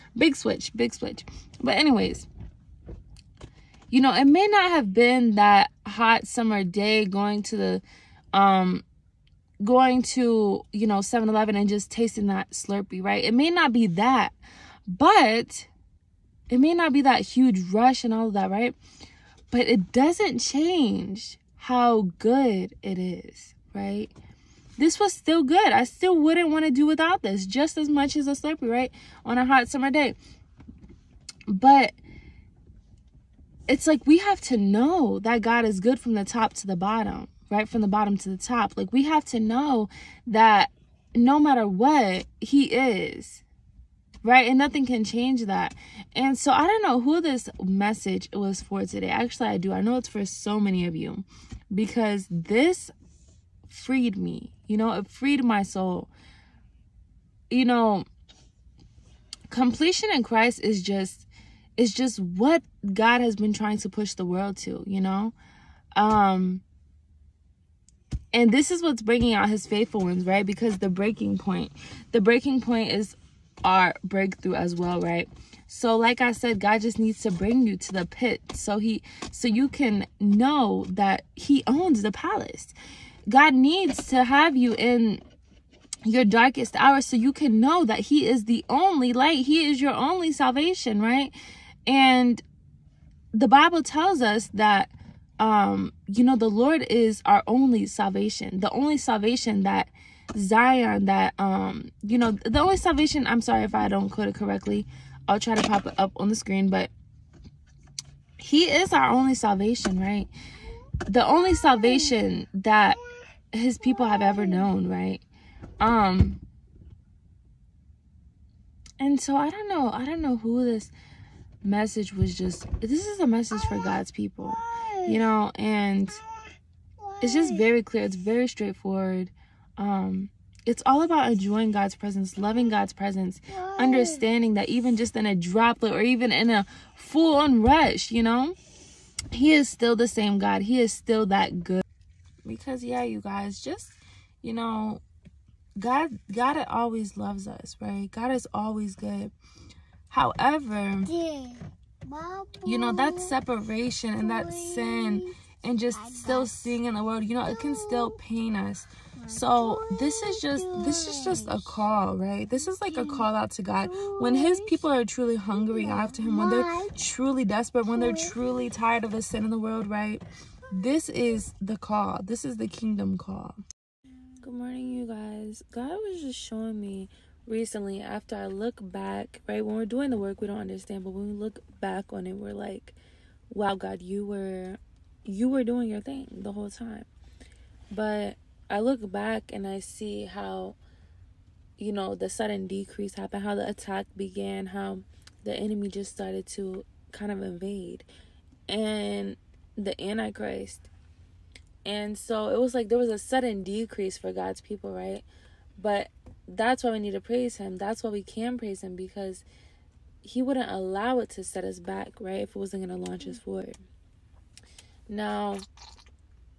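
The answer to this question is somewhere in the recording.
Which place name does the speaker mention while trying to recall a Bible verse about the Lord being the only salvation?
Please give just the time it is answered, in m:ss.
1:40.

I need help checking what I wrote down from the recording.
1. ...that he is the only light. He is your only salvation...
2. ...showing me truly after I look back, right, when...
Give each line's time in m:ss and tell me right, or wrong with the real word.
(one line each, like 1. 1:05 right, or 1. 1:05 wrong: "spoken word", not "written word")
1. 1:27 right
2. 2:56 wrong: "recently", not "truly".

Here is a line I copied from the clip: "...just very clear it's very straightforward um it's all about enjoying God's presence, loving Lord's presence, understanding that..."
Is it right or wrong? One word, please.
wrong.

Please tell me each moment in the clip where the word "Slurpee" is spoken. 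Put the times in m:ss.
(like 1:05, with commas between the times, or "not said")
0:12, 0:28.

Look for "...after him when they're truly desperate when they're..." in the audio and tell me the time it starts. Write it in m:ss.
2:45.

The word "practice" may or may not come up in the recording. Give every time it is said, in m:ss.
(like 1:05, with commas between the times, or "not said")
not said.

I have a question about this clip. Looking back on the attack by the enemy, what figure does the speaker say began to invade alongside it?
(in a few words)
the antichrist.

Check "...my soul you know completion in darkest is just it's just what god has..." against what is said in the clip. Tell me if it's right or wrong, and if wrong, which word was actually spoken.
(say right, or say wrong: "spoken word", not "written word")
wrong: "christ", not "darkest".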